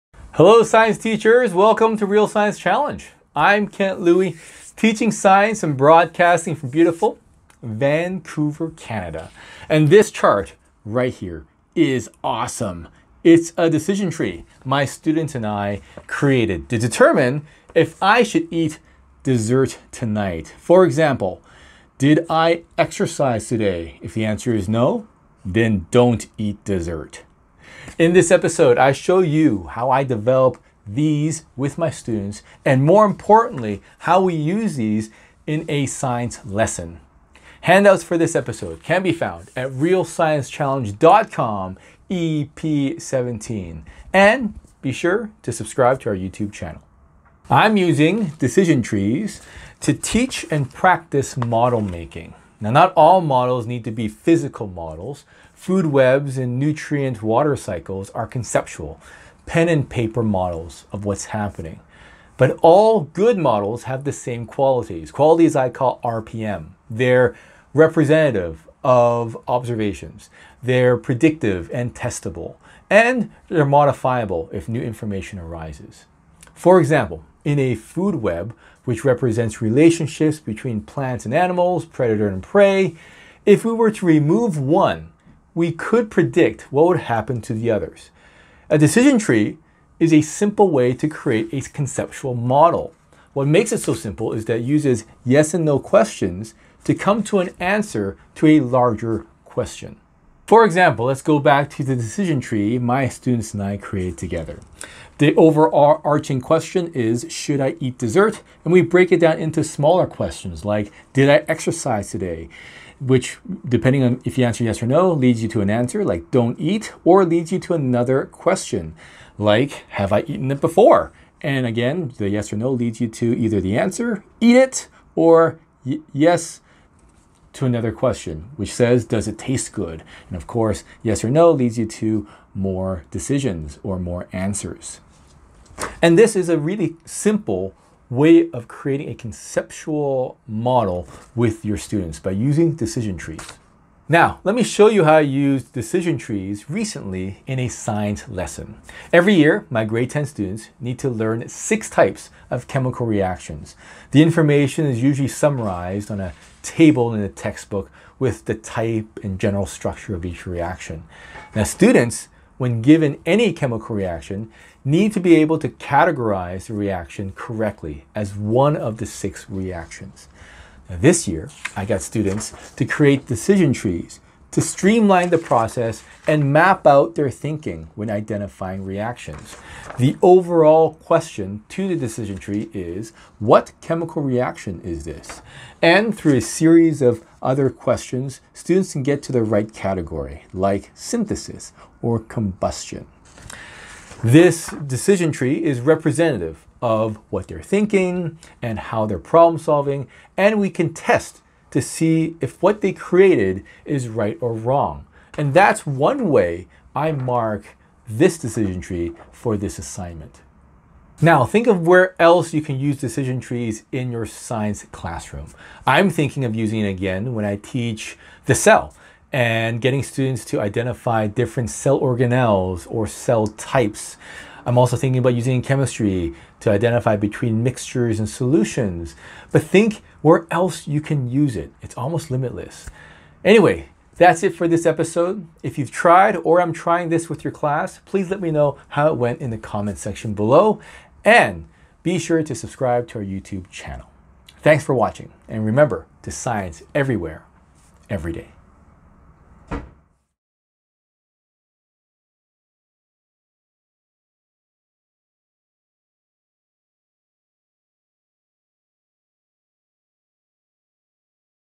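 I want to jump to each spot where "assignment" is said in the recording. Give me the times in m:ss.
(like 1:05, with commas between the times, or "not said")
3:29.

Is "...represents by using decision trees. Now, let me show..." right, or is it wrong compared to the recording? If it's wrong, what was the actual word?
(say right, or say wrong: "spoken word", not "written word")
wrong: "students", not "represents".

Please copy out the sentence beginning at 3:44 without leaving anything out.
I'm also thinking about using chemistry to identify between mixtures and solutions.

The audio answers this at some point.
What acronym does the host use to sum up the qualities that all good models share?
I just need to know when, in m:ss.
1:06.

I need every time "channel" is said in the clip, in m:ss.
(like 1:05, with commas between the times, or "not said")
0:46, 4:03.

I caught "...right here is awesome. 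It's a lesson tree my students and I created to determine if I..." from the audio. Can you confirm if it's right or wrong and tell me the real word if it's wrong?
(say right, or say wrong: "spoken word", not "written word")
wrong: "decision", not "lesson".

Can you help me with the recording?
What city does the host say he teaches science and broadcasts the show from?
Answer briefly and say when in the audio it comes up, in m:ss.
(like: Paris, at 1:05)
Vancouver, at 0:07.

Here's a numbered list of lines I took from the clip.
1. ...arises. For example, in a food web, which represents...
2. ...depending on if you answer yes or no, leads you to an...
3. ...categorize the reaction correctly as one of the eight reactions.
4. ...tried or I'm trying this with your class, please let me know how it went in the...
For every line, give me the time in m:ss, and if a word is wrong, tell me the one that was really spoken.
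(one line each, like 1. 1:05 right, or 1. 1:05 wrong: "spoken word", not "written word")
1. 1:15 right
2. 1:53 right
3. 2:45 wrong: "six", not "eight"
4. 3:55 right.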